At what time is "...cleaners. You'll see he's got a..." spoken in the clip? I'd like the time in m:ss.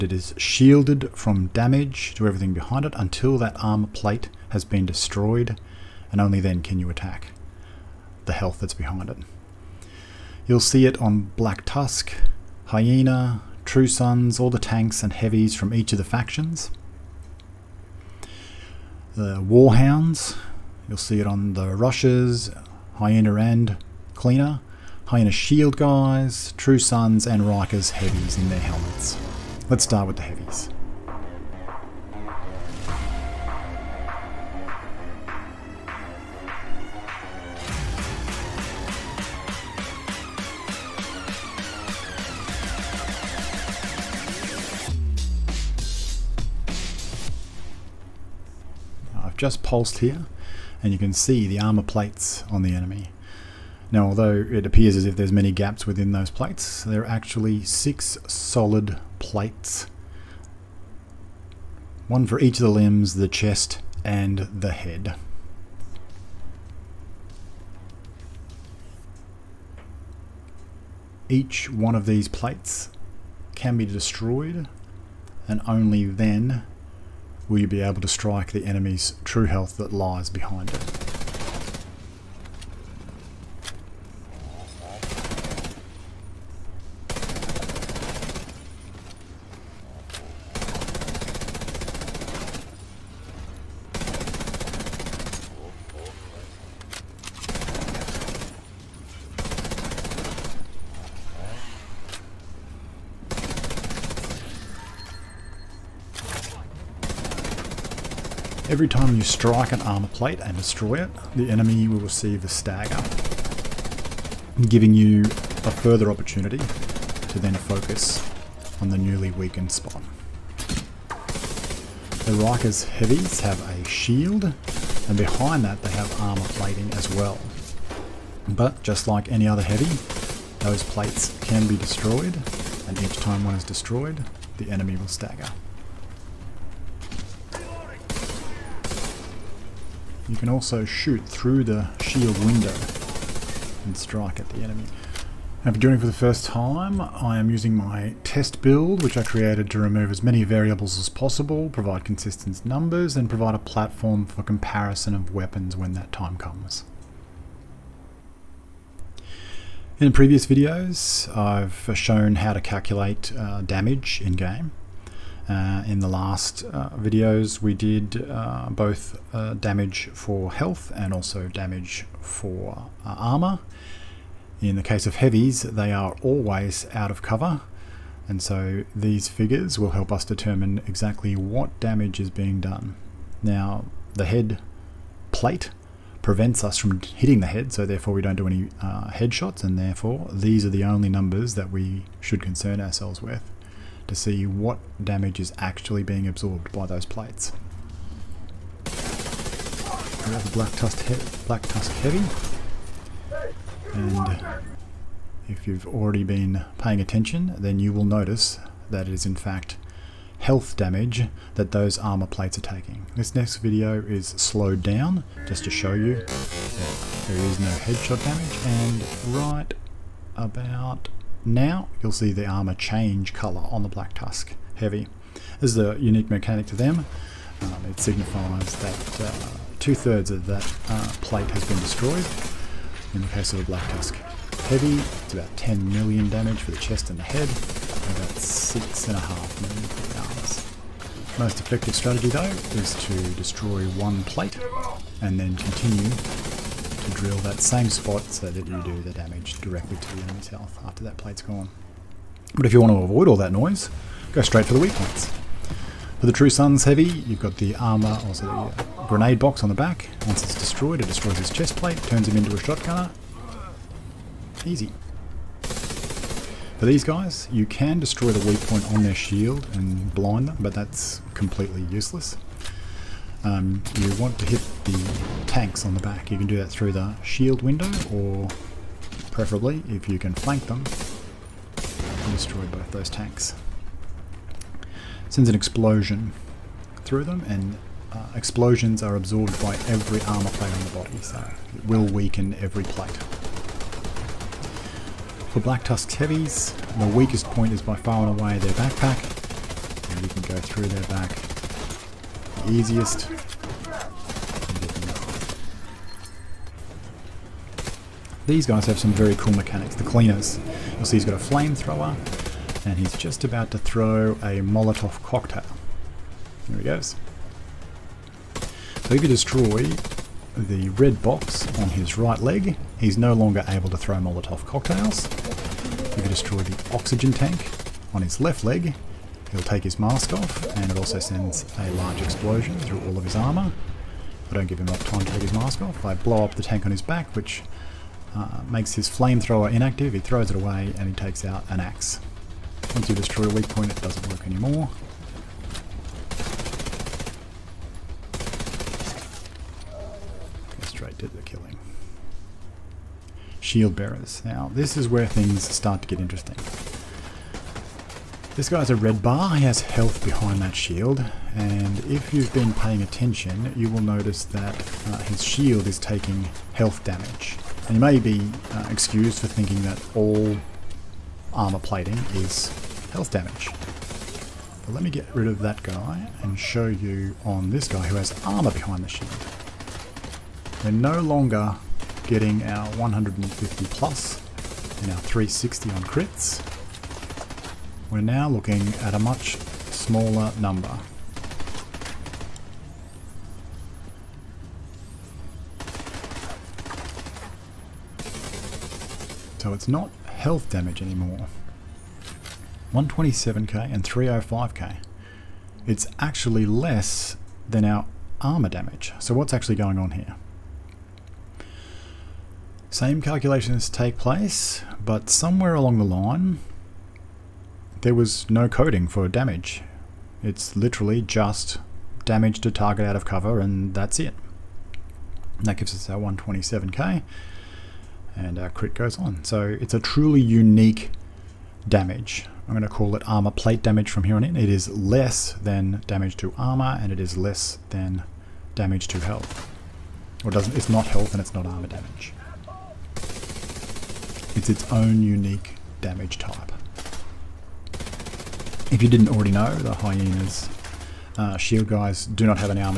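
5:10.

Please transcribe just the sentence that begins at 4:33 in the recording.
Um, you want to hit the tanks on the back.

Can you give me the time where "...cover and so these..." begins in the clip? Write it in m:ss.
2:57.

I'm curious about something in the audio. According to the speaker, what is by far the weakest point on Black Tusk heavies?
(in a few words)
Their backpack.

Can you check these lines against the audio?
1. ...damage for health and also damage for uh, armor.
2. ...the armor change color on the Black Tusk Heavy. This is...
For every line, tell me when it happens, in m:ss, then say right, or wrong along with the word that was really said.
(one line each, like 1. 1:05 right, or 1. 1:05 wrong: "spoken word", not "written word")
1. 2:49 right
2. 3:42 right.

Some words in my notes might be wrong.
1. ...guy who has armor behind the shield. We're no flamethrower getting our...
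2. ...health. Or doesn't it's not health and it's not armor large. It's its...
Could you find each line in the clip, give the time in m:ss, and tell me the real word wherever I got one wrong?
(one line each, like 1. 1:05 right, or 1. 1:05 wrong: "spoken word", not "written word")
1. 6:17 wrong: "longer", not "flamethrower"
2. 7:19 wrong: "damage", not "large".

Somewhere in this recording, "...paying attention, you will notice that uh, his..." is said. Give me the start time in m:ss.
6:02.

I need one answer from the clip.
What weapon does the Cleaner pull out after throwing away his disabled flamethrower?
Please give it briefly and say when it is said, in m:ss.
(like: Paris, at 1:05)
An axe, at 5:41.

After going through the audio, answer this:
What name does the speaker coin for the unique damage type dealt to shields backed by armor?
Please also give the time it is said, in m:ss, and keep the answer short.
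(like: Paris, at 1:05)
Armor plate damage, at 7:13.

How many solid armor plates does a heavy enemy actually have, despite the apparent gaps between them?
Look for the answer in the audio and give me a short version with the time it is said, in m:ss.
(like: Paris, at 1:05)
6, at 0:57.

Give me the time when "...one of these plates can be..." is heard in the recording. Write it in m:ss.
1:11.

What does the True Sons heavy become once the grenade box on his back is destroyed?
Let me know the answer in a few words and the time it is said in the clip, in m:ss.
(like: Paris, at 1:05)
A shotgunner, at 4:22.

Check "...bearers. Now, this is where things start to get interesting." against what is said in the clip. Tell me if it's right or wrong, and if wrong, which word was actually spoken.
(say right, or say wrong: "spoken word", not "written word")
right.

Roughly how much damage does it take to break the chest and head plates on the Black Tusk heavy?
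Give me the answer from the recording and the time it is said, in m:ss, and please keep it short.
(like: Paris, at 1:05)
10 million, at 3:55.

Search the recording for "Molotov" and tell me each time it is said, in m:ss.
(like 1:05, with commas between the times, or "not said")
5:14, 5:24.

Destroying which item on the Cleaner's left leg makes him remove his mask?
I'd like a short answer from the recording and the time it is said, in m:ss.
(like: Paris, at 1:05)
Oxygen tank, at 5:26.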